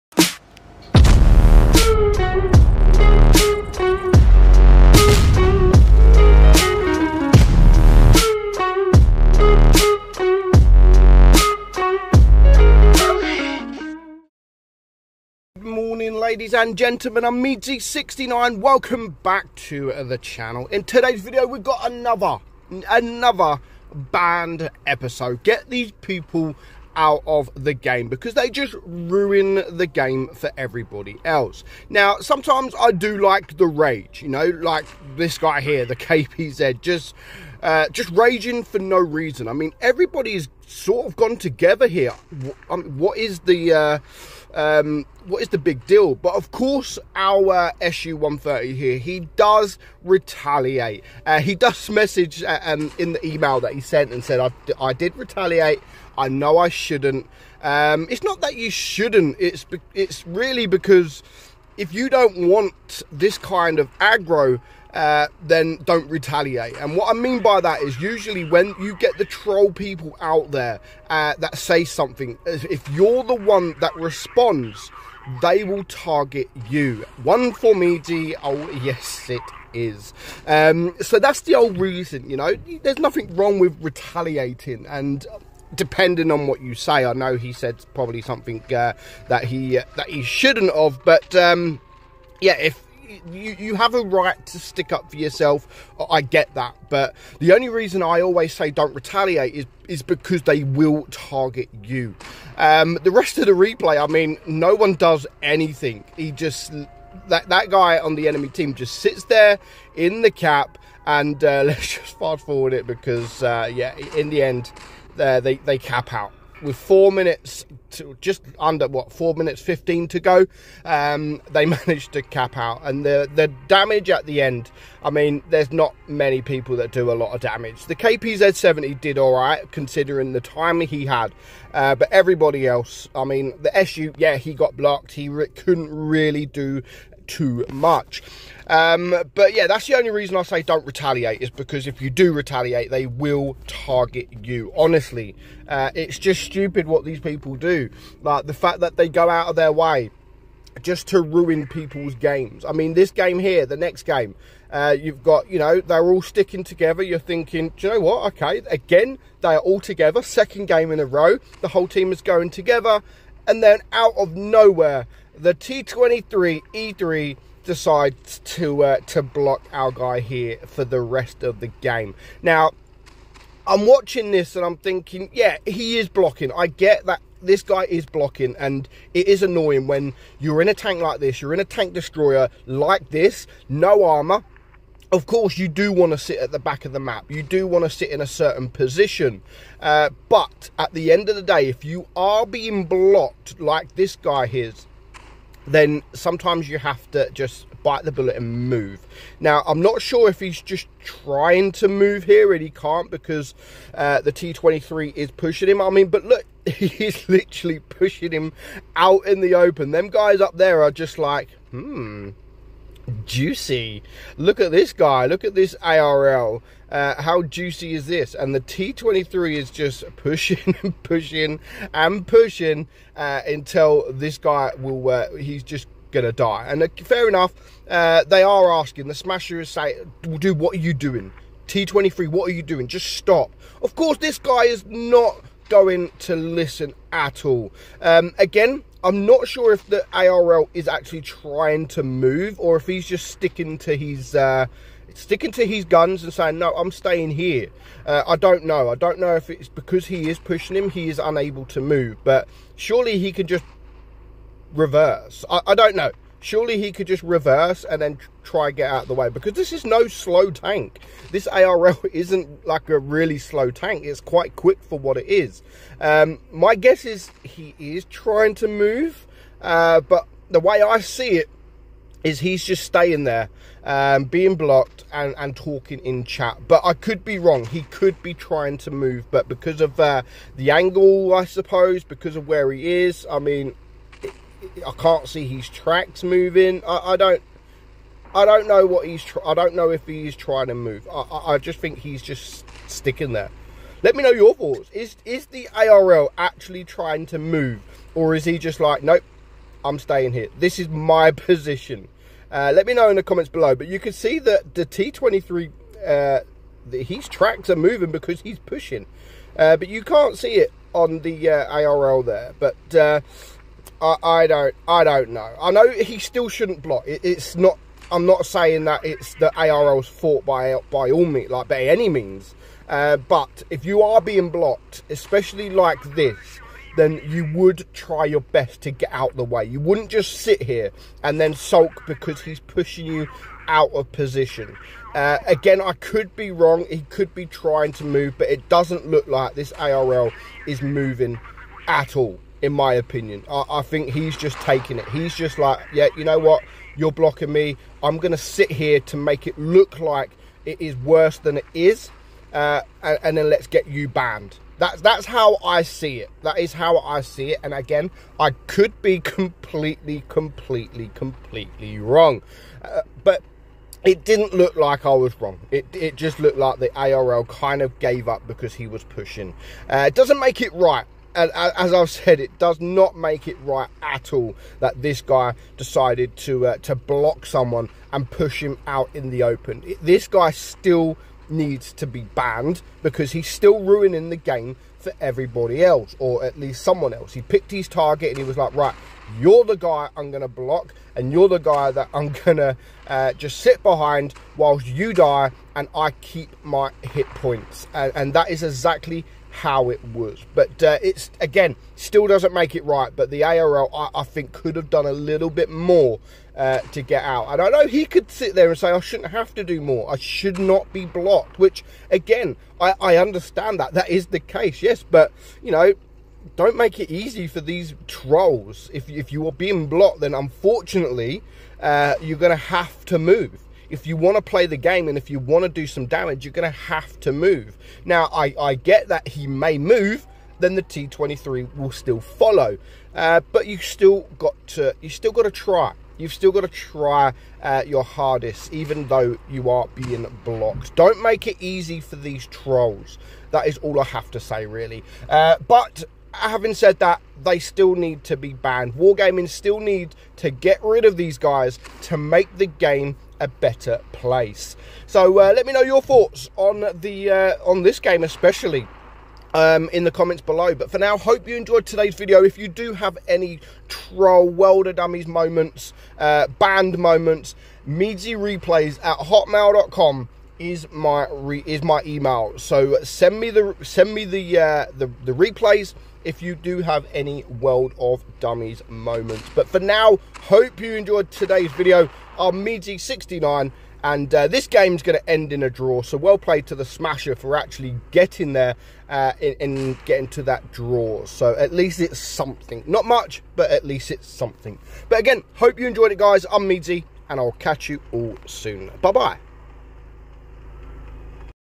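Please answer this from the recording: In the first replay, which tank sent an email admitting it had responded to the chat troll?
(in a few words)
SU 130.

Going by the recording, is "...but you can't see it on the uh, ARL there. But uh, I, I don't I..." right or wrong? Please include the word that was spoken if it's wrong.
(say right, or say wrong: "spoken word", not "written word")
right.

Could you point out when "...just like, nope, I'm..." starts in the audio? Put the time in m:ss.
4:58.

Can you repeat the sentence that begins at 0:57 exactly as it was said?
Um, it's not that you shouldn't, it's, it's really because if you don't want this kind of aggro, uh, then don't retaliate.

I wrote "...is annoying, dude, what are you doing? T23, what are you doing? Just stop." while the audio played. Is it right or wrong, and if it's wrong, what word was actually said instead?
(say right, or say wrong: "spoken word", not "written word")
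wrong: "saying", not "annoying".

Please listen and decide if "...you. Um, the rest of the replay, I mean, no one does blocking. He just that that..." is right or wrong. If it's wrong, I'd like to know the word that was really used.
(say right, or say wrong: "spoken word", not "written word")
wrong: "anything", not "blocking".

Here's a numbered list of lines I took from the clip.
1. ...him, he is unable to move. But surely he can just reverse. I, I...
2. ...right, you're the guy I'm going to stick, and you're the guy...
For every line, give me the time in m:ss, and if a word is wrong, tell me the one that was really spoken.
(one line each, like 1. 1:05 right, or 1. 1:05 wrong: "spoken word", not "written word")
1. 4:10 right
2. 6:28 wrong: "block", not "stick".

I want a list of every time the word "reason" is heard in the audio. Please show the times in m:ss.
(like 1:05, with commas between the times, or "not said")
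0:38, 1:21, 1:37, 2:20.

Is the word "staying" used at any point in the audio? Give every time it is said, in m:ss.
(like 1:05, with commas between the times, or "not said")
4:06, 4:32, 4:59.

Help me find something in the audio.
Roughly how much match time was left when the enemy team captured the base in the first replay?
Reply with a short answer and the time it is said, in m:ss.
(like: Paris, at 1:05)
just under 4 minutes 15, at 1:59.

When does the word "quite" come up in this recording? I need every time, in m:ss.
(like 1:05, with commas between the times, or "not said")
4:24.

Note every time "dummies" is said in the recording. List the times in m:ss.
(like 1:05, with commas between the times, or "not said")
7:44, 7:58.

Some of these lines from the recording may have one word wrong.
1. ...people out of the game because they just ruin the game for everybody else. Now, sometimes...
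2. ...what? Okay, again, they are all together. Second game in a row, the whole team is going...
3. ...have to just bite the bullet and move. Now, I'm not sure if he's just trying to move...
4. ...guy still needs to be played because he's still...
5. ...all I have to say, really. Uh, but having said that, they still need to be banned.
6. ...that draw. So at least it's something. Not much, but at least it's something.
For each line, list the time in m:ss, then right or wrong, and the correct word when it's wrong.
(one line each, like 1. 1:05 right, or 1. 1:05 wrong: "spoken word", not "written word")
1. 0:26 right
2. 2:37 right
3. 3:16 right
4. 6:20 wrong: "banned", not "played"
5. 7:23 right
6. 8:10 right.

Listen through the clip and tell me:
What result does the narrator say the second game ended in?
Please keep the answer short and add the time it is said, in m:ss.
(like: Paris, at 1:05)
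a draw, at 8:05.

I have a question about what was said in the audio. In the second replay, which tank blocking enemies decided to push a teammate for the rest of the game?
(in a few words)
T23 E3.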